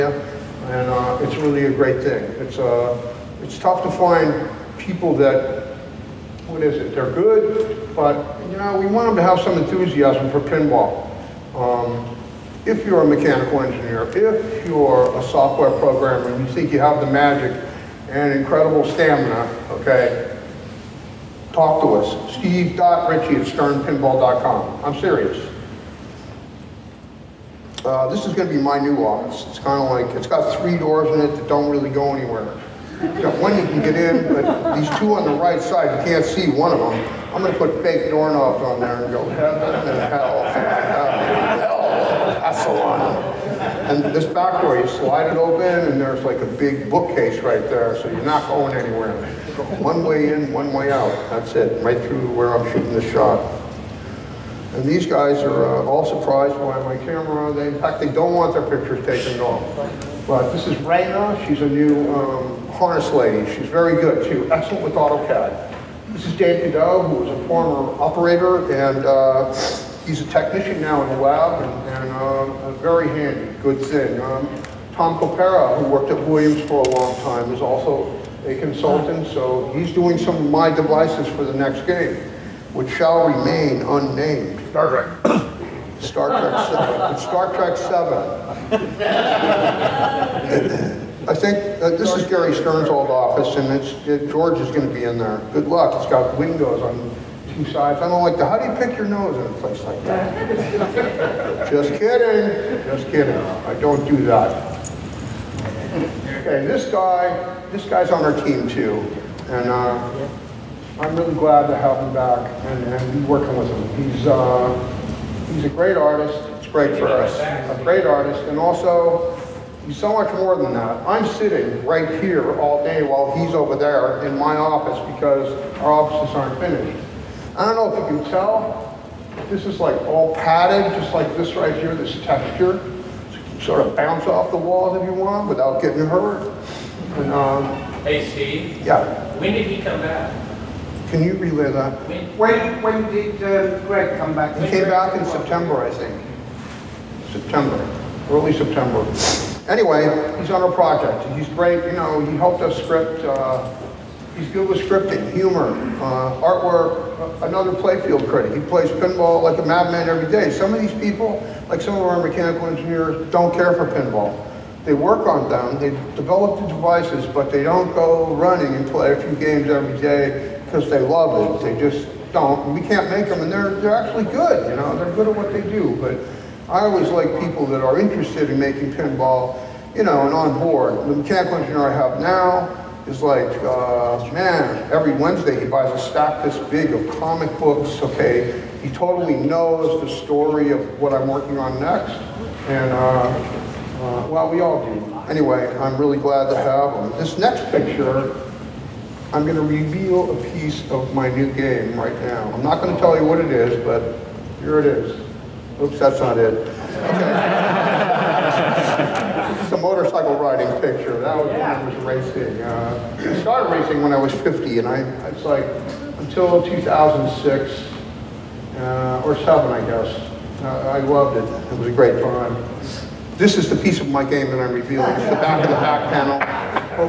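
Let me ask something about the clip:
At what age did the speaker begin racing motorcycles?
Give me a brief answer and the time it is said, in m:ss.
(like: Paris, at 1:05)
50, at 3:34.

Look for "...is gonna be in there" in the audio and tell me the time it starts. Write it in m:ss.
1:34.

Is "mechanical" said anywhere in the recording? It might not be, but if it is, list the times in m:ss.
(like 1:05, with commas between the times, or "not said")
0:13, 2:42, 3:01.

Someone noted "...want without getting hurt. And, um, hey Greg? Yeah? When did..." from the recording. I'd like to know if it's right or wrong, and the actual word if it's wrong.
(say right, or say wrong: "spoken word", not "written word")
wrong: "Steve", not "Greg".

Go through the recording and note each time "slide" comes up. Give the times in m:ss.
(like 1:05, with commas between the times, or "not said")
0:44.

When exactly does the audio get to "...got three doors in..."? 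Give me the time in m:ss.
0:30.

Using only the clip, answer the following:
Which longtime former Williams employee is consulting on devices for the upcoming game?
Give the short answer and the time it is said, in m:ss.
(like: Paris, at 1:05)
Tom Copera, at 1:14.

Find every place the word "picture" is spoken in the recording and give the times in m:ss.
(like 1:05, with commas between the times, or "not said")
0:58, 3:17, 3:30.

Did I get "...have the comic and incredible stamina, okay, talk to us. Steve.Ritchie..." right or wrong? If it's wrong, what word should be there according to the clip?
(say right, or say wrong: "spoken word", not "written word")
wrong: "magic", not "comic".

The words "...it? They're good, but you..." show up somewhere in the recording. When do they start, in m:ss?
0:06.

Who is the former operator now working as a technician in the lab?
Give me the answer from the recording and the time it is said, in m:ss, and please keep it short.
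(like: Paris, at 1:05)
Dan Cadeau, at 1:06.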